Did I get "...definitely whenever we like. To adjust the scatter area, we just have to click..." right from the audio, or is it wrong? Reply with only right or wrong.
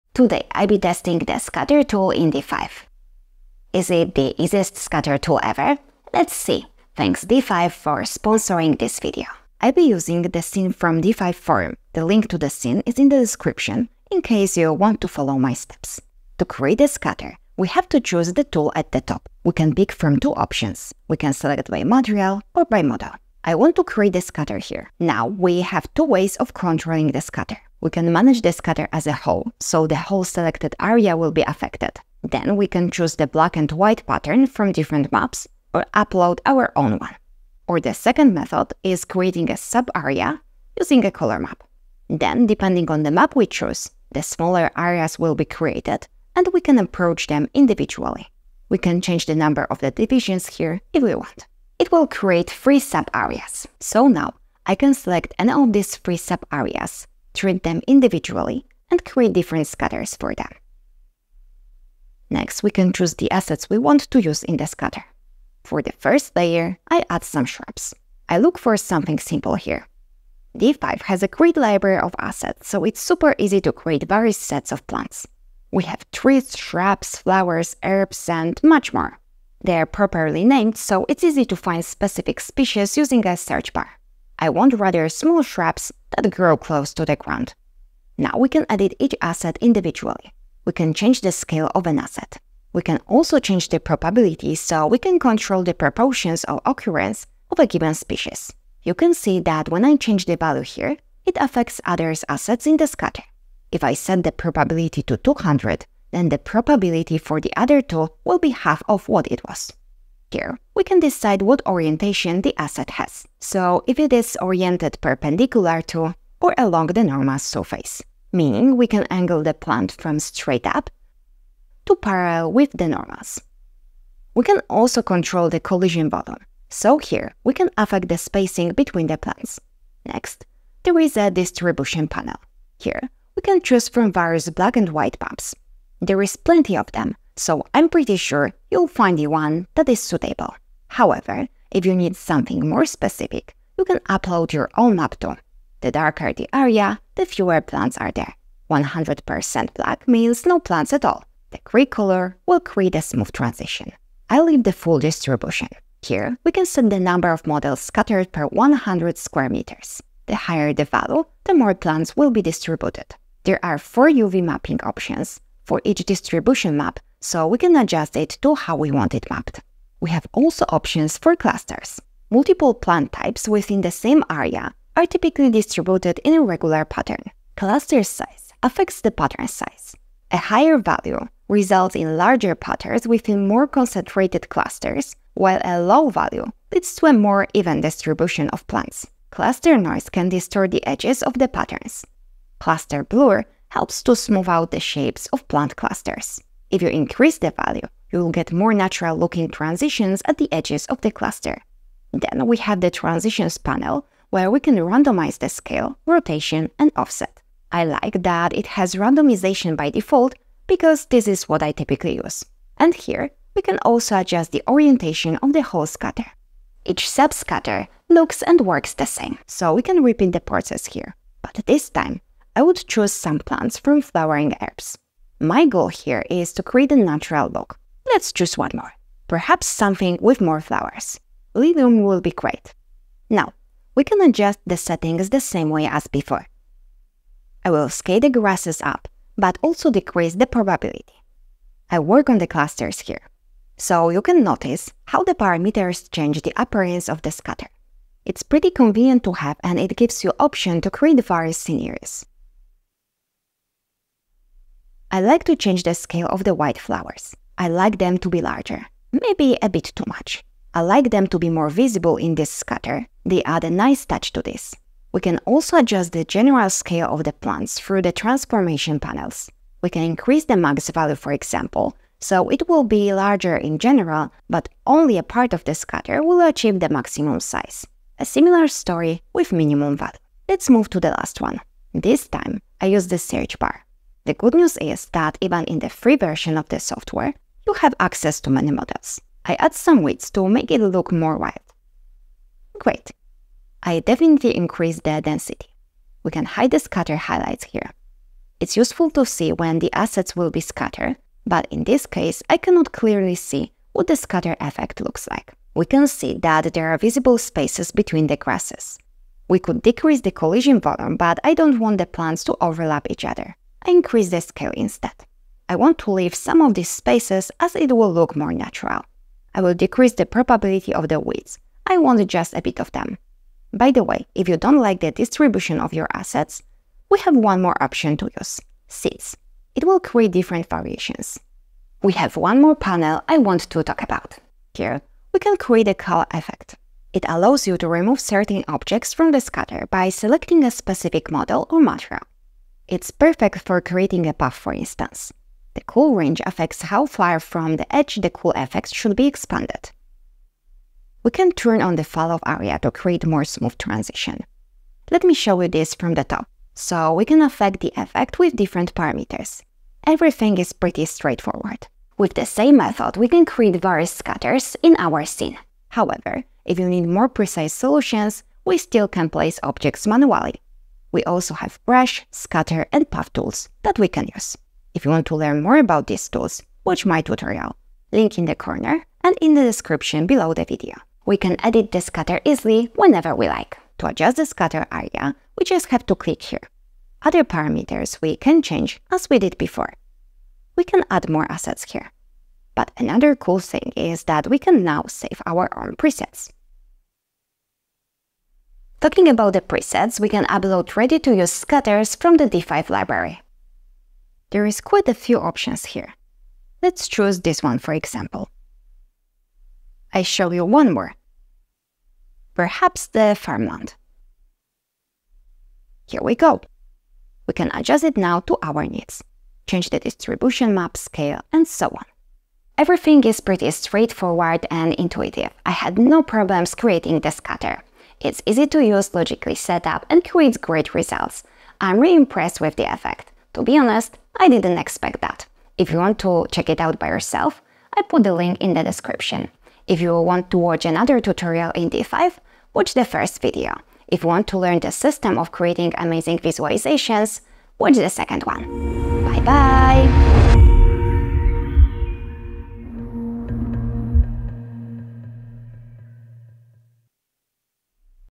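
wrong.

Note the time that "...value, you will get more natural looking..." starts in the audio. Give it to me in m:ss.
3:17.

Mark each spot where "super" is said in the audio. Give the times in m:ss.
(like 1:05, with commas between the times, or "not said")
1:13.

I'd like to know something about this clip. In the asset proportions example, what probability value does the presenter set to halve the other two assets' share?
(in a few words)
200.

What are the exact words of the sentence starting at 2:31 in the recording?
The gray color will create a smooth transition.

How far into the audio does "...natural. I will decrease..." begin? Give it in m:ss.
5:18.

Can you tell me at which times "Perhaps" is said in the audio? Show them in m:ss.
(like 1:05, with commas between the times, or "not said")
3:49, 6:52.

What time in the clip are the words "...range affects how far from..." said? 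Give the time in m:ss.
5:46.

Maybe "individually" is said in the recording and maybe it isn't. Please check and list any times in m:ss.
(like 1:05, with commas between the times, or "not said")
0:47, 0:57, 1:29.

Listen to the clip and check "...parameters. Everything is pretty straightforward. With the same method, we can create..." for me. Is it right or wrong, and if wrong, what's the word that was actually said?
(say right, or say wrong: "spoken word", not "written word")
right.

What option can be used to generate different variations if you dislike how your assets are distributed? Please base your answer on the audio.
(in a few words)
Seeds.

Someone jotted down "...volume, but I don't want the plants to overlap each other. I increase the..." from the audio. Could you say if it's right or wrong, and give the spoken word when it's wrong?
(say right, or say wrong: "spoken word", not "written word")
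right.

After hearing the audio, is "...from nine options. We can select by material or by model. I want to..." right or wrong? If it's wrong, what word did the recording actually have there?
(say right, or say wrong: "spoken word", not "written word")
wrong: "two", not "nine".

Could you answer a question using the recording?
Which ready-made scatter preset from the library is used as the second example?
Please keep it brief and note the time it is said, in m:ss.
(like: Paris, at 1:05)
Farmland, at 6:53.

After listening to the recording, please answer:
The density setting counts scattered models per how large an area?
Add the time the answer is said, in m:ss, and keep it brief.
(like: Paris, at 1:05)
100 square meters, at 2:38.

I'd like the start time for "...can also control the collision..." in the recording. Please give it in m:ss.
2:04.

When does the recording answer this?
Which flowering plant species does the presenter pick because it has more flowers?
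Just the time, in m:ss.
3:51.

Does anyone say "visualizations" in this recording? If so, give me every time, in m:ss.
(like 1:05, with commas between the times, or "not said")
7:26.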